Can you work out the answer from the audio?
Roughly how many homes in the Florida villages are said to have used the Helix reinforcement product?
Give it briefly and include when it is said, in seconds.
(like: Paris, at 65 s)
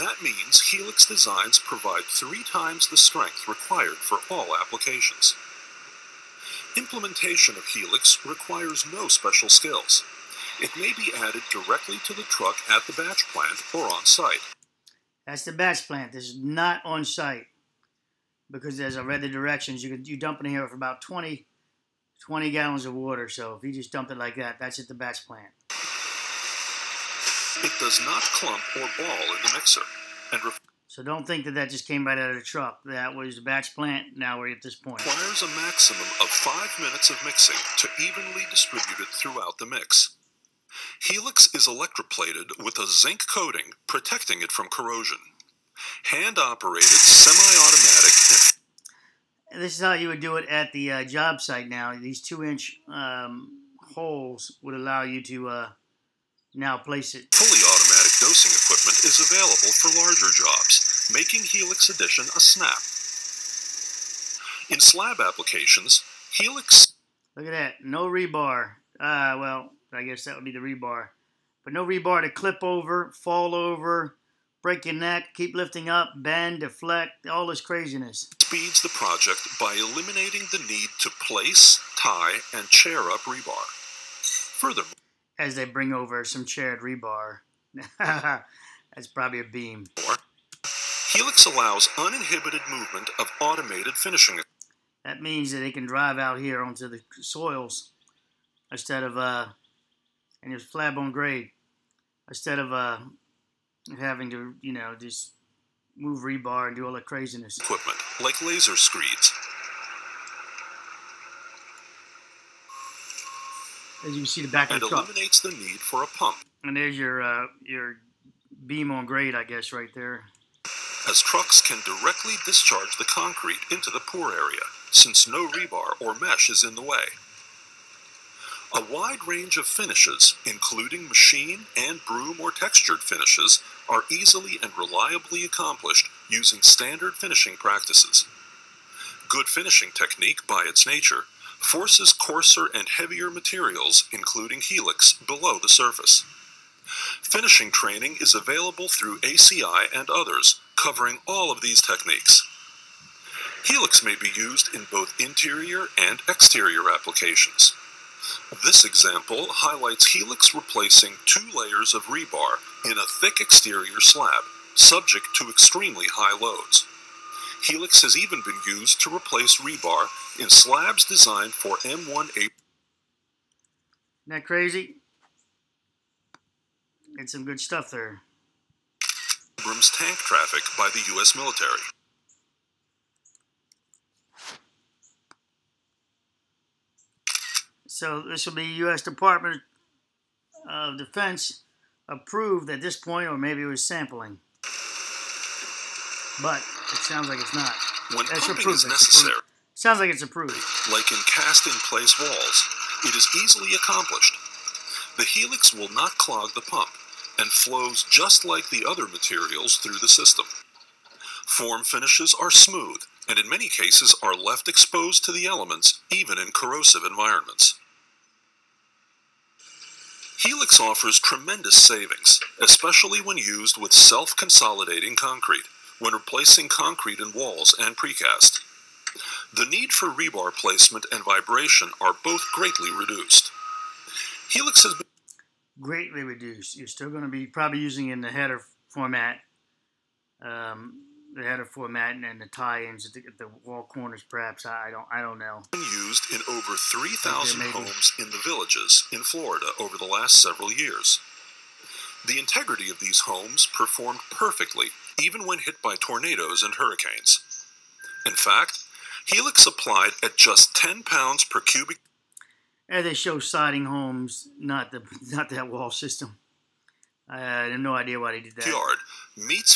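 over 3,000, at 246 s.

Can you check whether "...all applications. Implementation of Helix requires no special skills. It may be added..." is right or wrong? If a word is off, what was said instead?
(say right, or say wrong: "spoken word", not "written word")
right.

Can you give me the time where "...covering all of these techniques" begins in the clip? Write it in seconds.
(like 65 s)
150 s.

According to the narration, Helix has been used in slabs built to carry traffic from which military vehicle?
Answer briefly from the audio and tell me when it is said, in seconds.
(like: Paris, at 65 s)
M1A Abrams tank, at 171 s.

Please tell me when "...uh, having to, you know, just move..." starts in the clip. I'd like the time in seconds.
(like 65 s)
102 s.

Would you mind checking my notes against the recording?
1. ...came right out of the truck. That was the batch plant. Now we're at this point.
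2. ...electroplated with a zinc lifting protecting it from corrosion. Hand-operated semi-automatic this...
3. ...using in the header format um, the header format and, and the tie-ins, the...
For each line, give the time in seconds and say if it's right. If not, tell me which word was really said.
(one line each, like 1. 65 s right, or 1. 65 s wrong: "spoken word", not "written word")
1. 31 s right
2. 41 s wrong: "coating", not "lifting"
3. 237 s right.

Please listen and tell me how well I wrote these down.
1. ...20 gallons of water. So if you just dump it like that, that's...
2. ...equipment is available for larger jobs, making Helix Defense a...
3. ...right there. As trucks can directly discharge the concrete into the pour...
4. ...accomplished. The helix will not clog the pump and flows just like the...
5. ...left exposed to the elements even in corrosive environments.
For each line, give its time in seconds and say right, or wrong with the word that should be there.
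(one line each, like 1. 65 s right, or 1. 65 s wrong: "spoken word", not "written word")
1. 22 s right
2. 58 s wrong: "Edition", not "Defense"
3. 119 s right
4. 203 s right
5. 214 s right.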